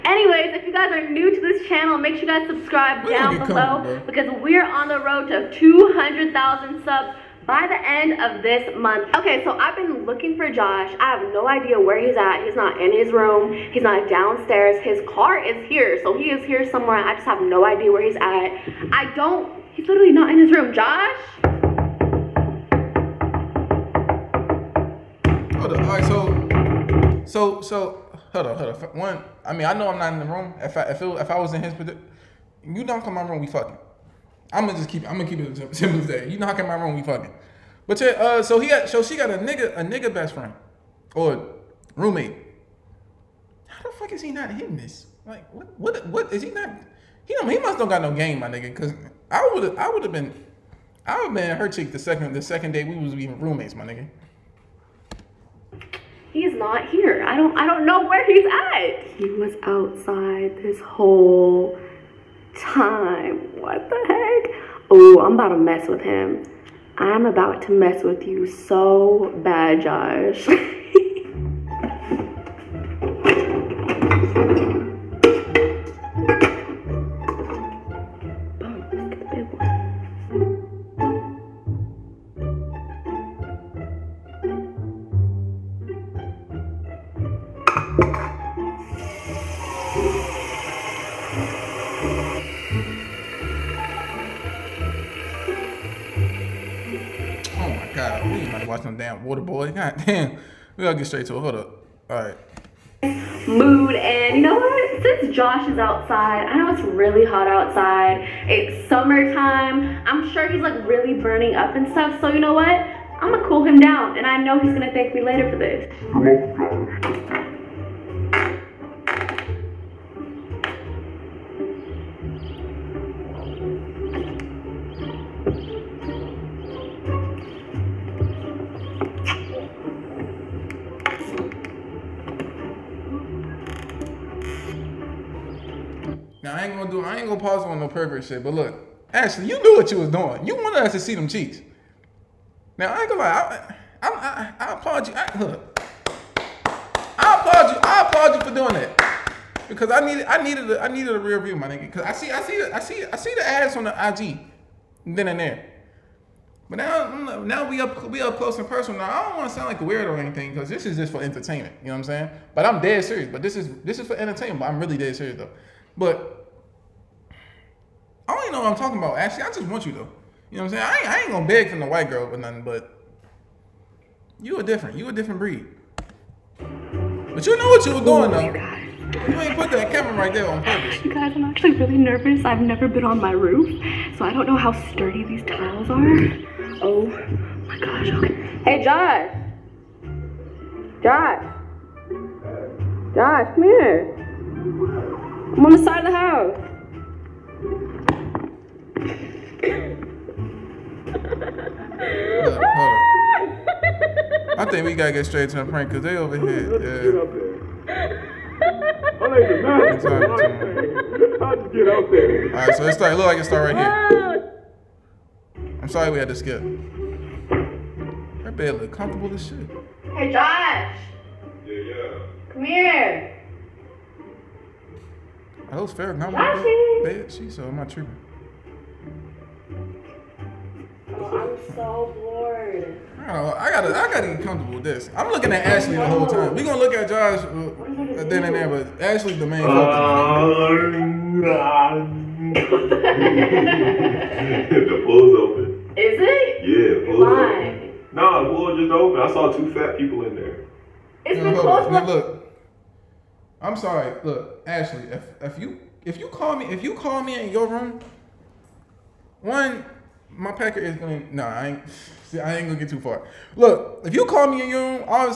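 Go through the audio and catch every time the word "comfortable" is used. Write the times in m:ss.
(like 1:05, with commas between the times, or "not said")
3:38, 3:54.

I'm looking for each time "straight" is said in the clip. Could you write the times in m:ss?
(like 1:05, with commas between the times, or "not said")
1:41, 3:25.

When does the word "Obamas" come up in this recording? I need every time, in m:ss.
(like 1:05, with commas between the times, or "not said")
not said.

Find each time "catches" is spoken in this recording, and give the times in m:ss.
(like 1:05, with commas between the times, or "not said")
not said.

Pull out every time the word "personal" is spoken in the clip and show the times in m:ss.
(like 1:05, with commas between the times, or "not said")
2:38.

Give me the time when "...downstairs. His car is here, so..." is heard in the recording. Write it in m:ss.
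0:14.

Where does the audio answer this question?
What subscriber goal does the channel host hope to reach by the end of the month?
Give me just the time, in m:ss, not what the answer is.
0:05.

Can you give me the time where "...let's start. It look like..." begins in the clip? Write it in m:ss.
3:32.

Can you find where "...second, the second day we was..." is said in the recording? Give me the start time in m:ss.
0:51.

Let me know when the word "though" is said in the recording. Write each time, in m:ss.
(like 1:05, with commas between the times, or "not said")
2:45, 2:49, 2:58.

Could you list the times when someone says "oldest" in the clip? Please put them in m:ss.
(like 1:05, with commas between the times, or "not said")
not said.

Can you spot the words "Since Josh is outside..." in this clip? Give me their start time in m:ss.
1:45.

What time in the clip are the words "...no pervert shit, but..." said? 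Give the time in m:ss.
2:17.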